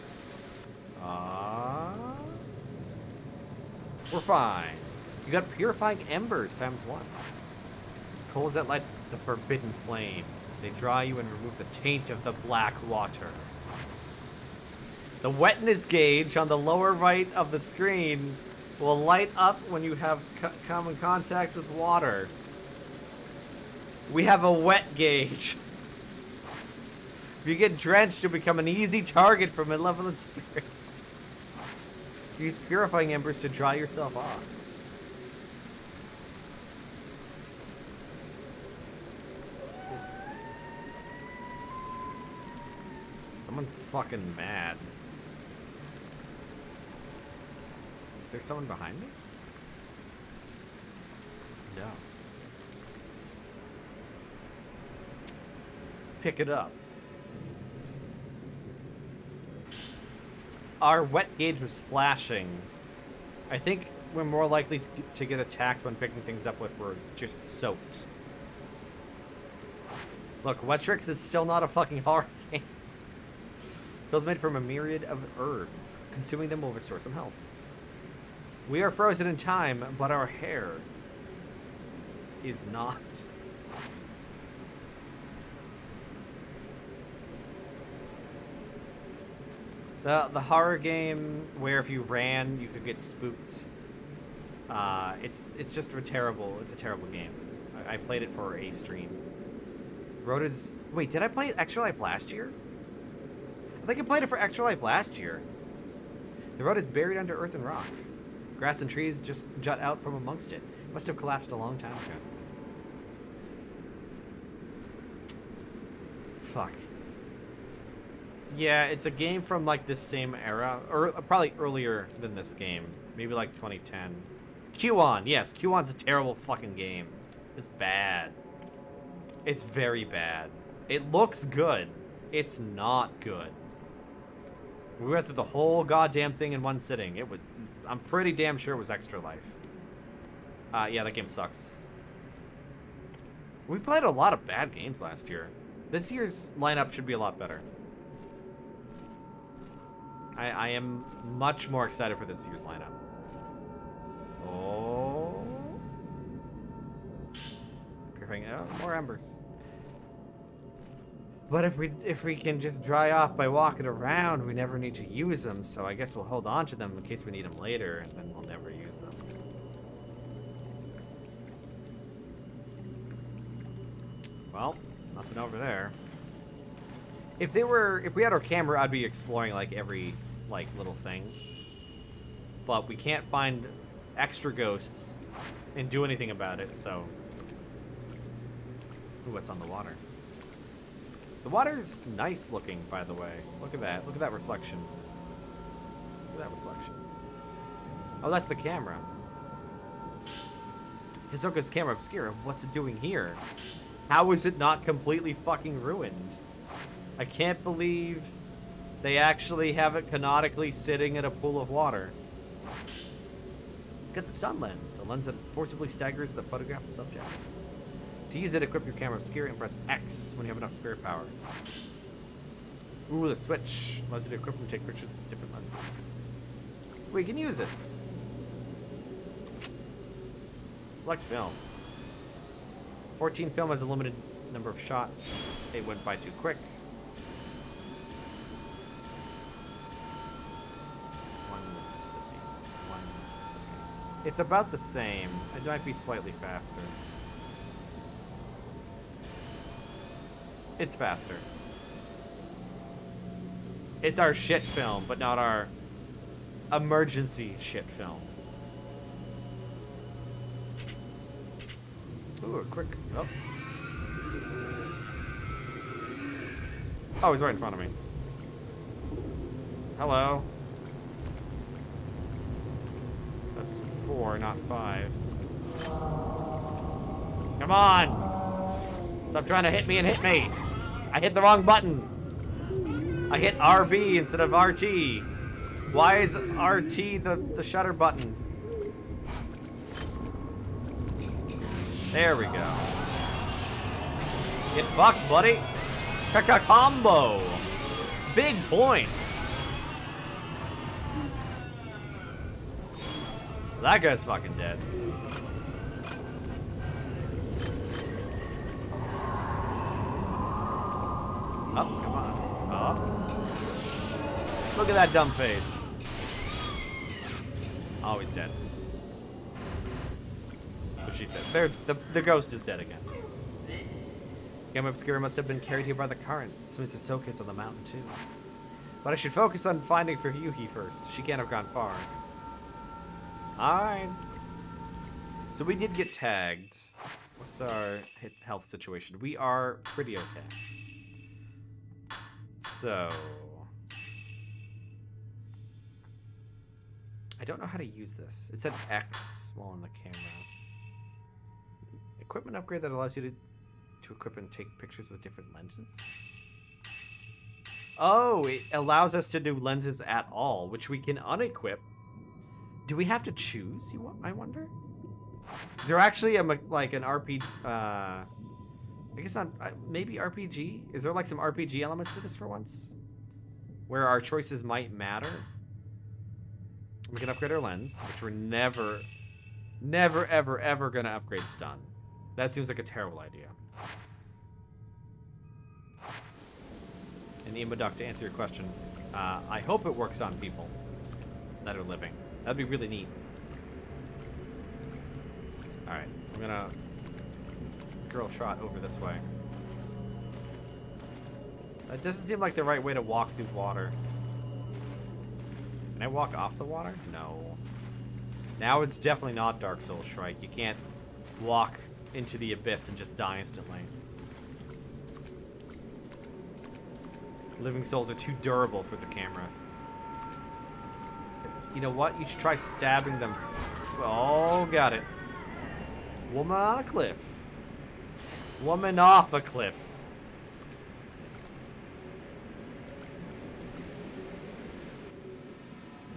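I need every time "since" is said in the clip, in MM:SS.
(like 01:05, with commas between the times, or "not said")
05:26.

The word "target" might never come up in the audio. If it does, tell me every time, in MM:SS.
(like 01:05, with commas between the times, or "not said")
00:29.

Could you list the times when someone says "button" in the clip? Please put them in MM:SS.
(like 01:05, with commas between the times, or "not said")
04:41, 04:47.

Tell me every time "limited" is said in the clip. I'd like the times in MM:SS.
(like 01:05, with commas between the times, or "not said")
03:53.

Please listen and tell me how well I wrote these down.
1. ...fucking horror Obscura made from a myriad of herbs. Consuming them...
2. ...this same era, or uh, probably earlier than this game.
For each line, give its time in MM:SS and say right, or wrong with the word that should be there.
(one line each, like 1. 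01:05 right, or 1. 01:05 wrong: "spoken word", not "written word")
1. 01:11 wrong: "Pills", not "Obscura"
2. 01:59 right.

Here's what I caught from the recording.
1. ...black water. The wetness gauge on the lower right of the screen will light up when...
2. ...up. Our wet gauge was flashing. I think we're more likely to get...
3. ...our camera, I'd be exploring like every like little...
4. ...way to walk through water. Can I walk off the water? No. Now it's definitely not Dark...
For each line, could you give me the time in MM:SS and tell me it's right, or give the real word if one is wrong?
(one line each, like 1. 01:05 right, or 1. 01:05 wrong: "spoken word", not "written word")
1. 00:12 right
2. 00:56 right
3. 02:58 right
4. 06:42 right.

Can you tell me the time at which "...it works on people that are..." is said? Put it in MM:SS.
06:29.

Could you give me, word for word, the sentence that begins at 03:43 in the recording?
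Ooh, the switch allows you to equip and take pictures with different lenses.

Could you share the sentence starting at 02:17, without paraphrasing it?
It was, I'm pretty damn sure it was Extra Life.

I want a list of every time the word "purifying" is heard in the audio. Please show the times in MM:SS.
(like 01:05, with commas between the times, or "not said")
00:05, 00:32.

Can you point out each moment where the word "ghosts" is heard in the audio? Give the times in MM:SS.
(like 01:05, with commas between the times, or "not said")
03:04, 05:22.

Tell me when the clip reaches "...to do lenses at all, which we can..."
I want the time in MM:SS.
05:59.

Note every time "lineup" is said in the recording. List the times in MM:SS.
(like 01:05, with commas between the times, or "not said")
02:26, 02:32.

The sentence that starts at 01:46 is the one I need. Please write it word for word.
The road is buried under earth and rock.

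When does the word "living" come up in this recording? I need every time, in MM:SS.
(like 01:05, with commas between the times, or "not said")
06:31, 06:57.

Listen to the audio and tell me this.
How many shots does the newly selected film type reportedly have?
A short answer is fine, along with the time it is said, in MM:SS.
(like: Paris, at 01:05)
14, at 03:53.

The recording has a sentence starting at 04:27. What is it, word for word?
Oh, he's right in front of me.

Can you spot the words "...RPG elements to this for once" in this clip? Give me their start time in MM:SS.
06:11.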